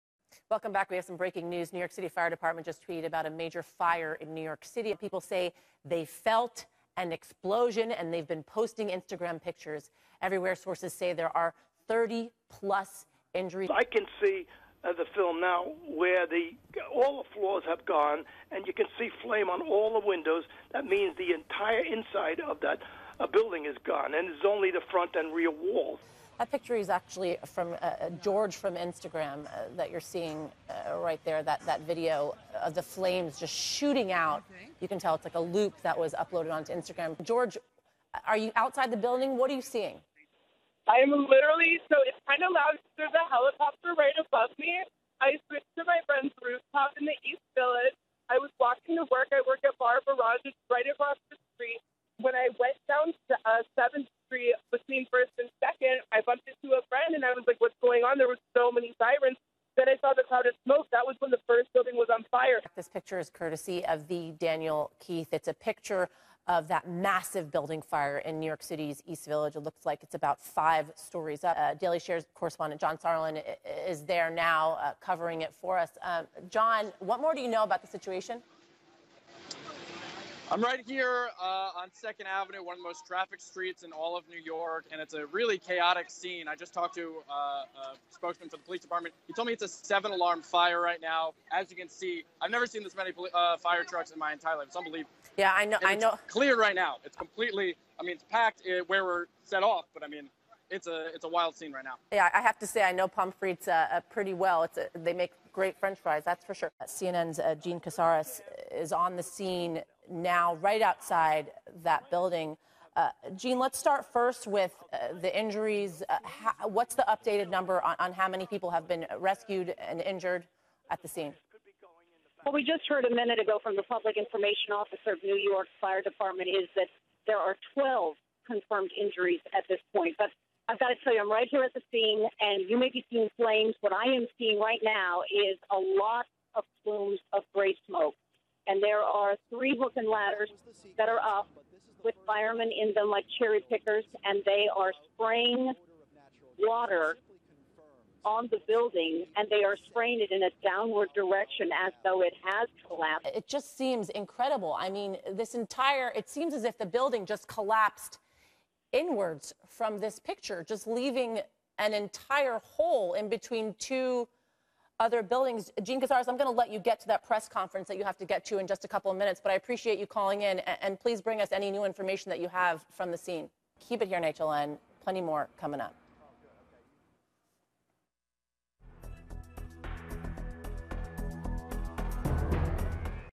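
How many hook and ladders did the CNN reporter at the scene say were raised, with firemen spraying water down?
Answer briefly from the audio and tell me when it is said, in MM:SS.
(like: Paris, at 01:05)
3, at 02:19.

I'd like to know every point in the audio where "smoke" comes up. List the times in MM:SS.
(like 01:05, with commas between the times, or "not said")
01:00, 02:17.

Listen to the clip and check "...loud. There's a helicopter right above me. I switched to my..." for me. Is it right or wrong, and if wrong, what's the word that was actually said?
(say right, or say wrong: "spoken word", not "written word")
right.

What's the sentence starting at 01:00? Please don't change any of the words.
That was when the first building was on fire.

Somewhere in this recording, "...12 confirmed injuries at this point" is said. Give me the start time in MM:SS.
02:07.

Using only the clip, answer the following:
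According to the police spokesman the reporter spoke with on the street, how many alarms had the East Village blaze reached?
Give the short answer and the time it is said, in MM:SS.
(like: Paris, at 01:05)
7, at 01:29.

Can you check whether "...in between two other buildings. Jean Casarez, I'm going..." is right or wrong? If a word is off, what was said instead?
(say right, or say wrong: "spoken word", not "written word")
right.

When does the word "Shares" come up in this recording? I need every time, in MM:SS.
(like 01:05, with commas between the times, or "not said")
01:11.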